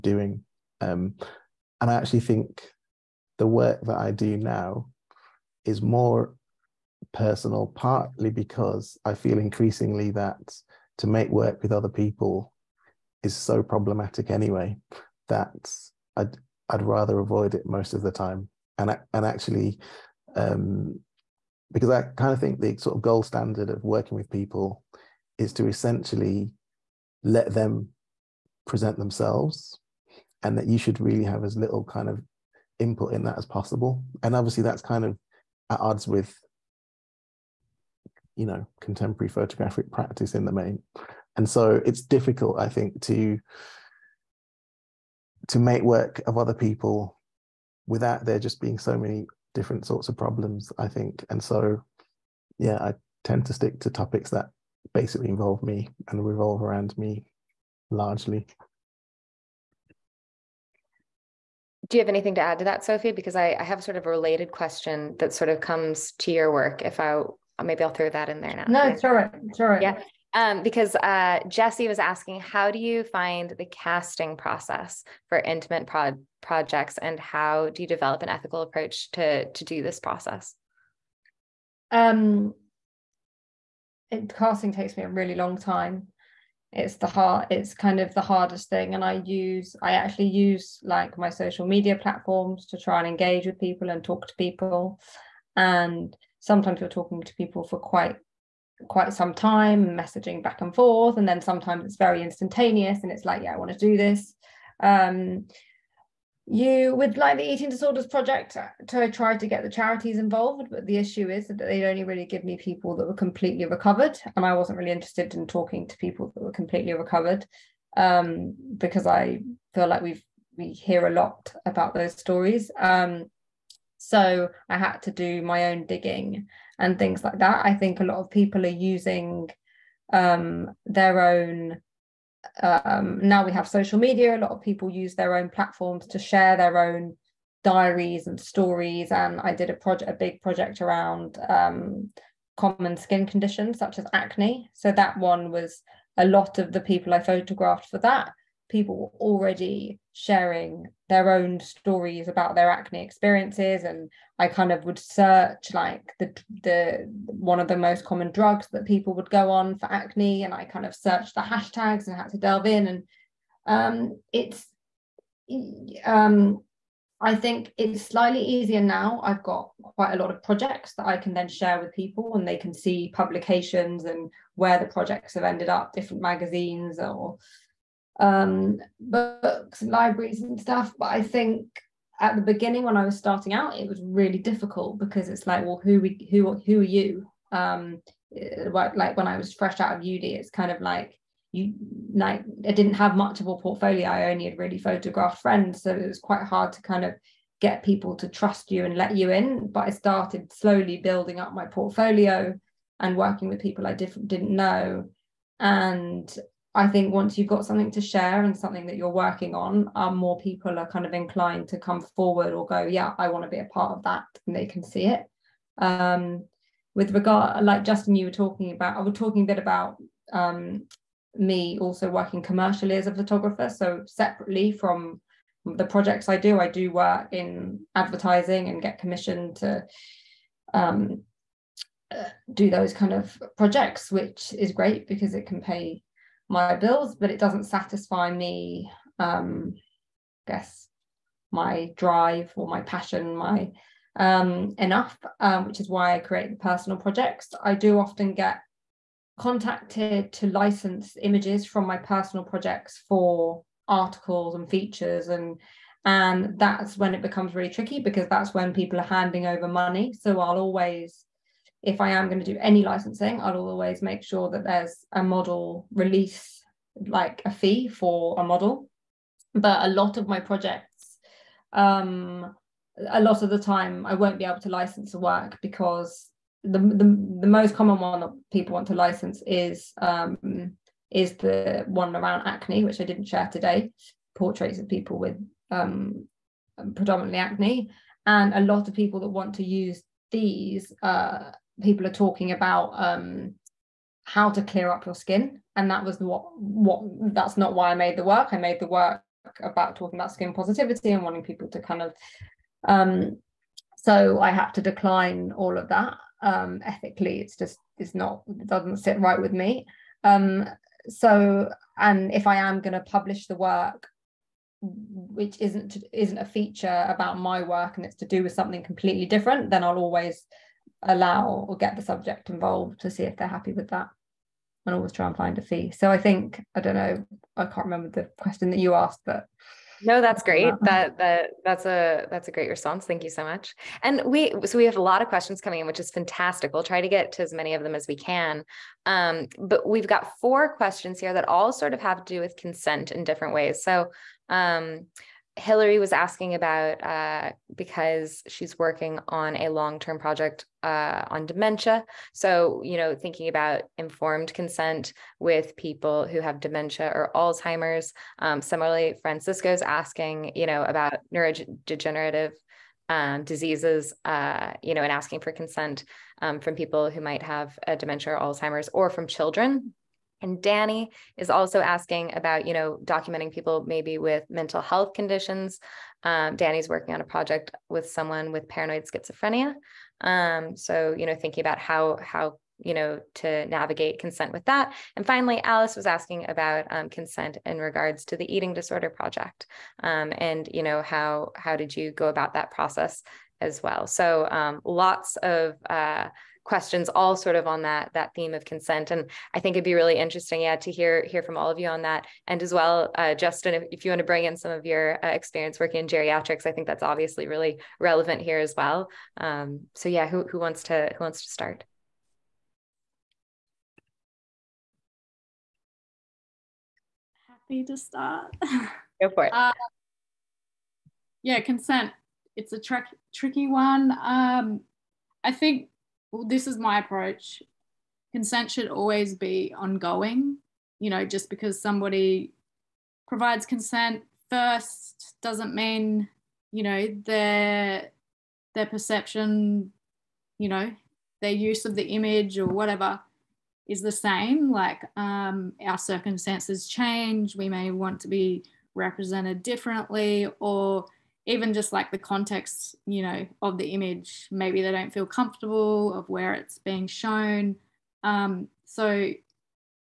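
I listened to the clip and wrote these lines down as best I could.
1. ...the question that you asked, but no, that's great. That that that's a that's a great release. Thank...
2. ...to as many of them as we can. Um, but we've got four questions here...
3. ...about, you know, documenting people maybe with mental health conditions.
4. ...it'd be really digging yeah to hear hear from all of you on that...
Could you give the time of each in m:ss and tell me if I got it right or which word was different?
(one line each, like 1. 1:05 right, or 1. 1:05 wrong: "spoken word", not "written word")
1. 5:28 wrong: "response", not "release"
2. 5:37 right
3. 6:12 right
4. 6:39 wrong: "interesting", not "digging".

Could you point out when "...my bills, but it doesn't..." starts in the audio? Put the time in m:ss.
3:56.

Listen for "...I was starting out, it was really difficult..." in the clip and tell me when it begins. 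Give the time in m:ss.
3:02.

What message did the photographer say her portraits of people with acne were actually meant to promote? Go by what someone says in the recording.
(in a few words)
skin positivity.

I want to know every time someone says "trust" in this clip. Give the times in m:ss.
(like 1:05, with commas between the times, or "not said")
3:18.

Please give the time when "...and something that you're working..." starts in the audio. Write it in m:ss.
3:28.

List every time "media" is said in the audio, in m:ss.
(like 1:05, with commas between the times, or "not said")
1:31, 2:13.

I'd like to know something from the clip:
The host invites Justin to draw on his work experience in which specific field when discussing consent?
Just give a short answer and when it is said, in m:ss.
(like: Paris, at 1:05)
geriatrics, at 6:46.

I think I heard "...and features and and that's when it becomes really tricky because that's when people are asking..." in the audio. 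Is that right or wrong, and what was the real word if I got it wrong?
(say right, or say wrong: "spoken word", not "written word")
wrong: "handing", not "asking".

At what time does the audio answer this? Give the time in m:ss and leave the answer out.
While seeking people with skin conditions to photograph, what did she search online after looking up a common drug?
2:41.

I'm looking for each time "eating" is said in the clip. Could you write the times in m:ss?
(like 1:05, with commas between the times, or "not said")
1:47, 6:28.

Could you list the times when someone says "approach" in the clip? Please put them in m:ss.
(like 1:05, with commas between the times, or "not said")
1:18, 7:06.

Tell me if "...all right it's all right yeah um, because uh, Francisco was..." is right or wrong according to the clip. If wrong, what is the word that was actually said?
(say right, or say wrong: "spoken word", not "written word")
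wrong: "Jesse", not "Francisco".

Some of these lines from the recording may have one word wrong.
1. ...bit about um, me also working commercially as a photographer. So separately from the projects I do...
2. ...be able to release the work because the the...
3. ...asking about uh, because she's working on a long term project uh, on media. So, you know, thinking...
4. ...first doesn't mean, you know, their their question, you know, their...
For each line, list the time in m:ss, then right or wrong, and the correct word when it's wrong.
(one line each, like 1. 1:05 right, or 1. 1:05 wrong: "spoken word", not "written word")
1. 3:39 right
2. 4:34 wrong: "license", not "release"
3. 5:46 wrong: "dementia", not "media"
4. 7:14 wrong: "perception", not "question".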